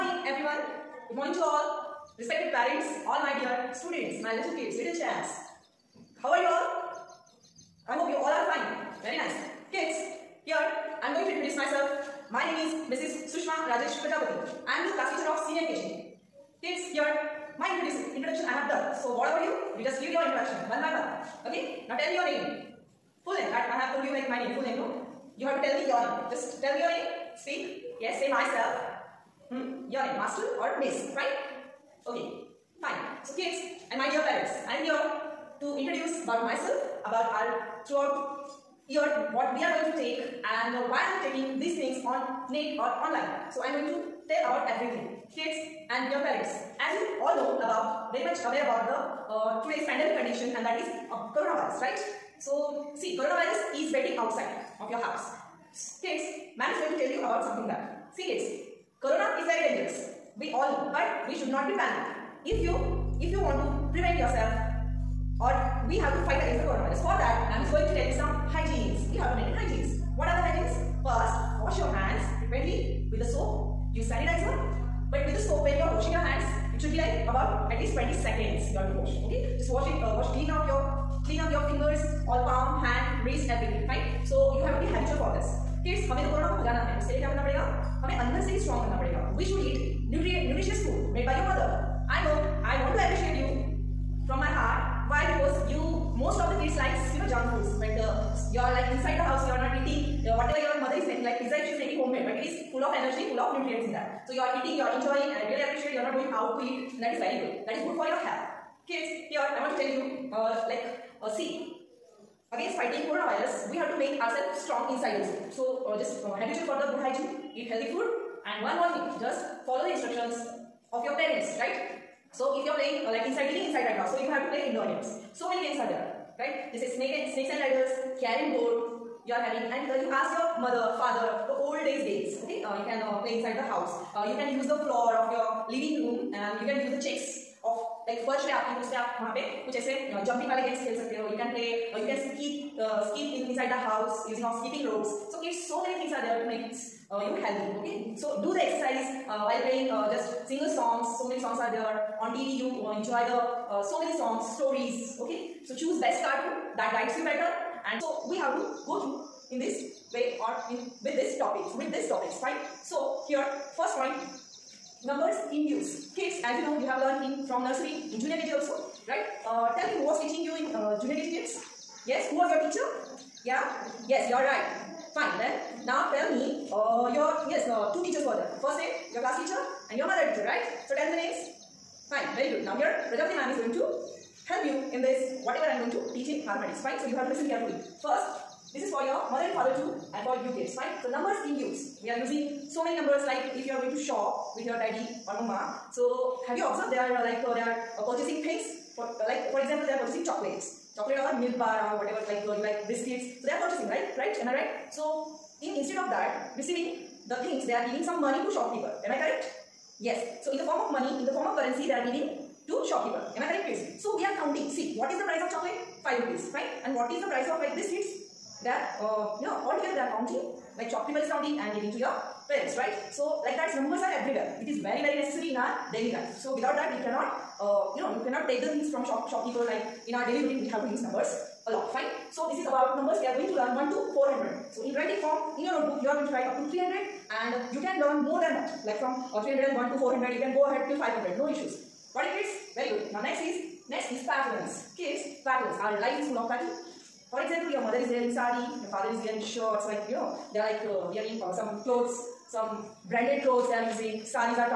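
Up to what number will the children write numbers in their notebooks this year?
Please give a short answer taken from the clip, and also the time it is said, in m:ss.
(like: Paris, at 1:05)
300, at 3:56.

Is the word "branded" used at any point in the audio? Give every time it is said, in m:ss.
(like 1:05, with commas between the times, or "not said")
4:13.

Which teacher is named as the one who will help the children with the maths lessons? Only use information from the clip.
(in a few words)
Prajapati ma'am.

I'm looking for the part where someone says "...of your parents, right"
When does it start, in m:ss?
2:00.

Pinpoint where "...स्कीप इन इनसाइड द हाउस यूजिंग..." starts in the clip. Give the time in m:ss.
2:23.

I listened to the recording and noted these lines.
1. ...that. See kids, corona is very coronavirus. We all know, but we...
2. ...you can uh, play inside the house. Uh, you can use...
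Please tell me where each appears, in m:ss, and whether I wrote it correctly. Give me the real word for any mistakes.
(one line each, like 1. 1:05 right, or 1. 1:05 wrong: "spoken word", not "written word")
1. 0:57 wrong: "dangerous", not "coronavirus"
2. 2:12 right.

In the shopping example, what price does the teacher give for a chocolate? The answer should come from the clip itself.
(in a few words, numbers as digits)
5 rupees.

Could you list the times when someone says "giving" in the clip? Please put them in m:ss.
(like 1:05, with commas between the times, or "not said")
3:27, 3:32, 3:41.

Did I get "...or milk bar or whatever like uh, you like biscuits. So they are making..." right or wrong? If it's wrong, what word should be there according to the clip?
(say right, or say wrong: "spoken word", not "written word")
wrong: "purchasing", not "making".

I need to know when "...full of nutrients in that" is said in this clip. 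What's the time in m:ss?
1:43.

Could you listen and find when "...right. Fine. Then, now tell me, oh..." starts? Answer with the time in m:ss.
2:54.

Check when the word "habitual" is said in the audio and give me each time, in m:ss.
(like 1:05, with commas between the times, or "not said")
1:24, 1:56.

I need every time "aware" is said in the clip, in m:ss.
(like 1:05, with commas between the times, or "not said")
0:48.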